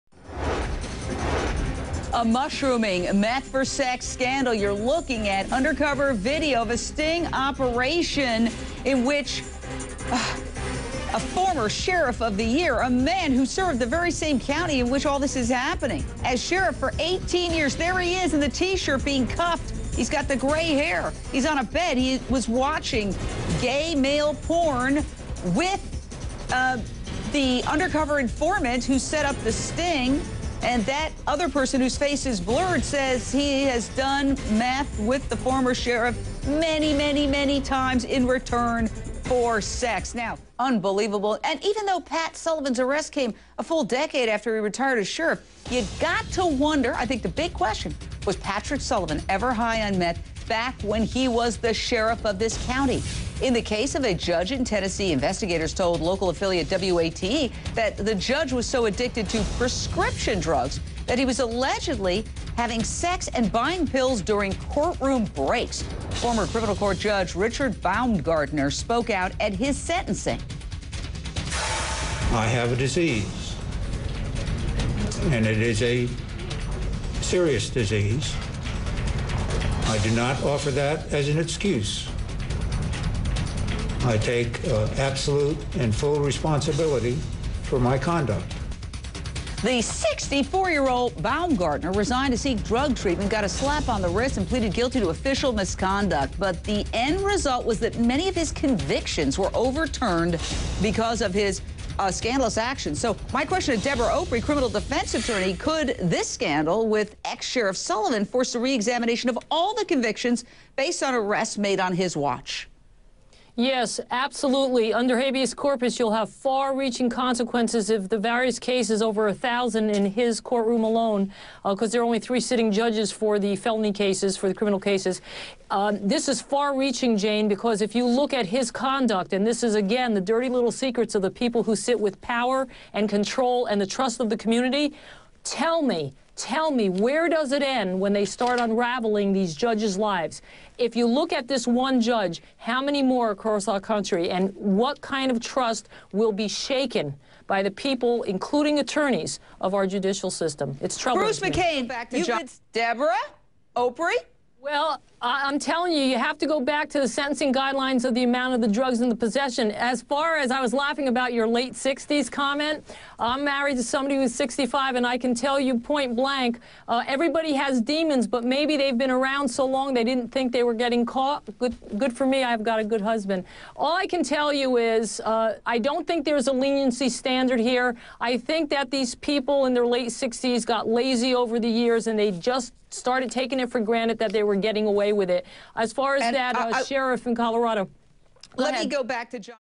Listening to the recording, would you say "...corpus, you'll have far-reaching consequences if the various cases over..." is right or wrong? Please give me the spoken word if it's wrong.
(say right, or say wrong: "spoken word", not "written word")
right.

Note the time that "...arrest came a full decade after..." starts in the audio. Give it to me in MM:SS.
00:42.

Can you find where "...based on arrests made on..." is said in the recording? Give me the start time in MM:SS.
01:50.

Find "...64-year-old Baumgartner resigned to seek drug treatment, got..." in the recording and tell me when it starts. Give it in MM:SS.
01:29.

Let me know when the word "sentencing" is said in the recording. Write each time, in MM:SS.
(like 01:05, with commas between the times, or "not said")
01:09, 02:37.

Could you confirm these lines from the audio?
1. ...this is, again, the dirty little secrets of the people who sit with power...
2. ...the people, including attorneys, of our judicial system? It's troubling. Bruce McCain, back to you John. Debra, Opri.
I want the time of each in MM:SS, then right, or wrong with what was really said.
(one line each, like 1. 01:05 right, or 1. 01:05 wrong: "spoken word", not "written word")
1. 02:09 right
2. 02:27 right.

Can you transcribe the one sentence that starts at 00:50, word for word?
back when he was the sheriff of this county.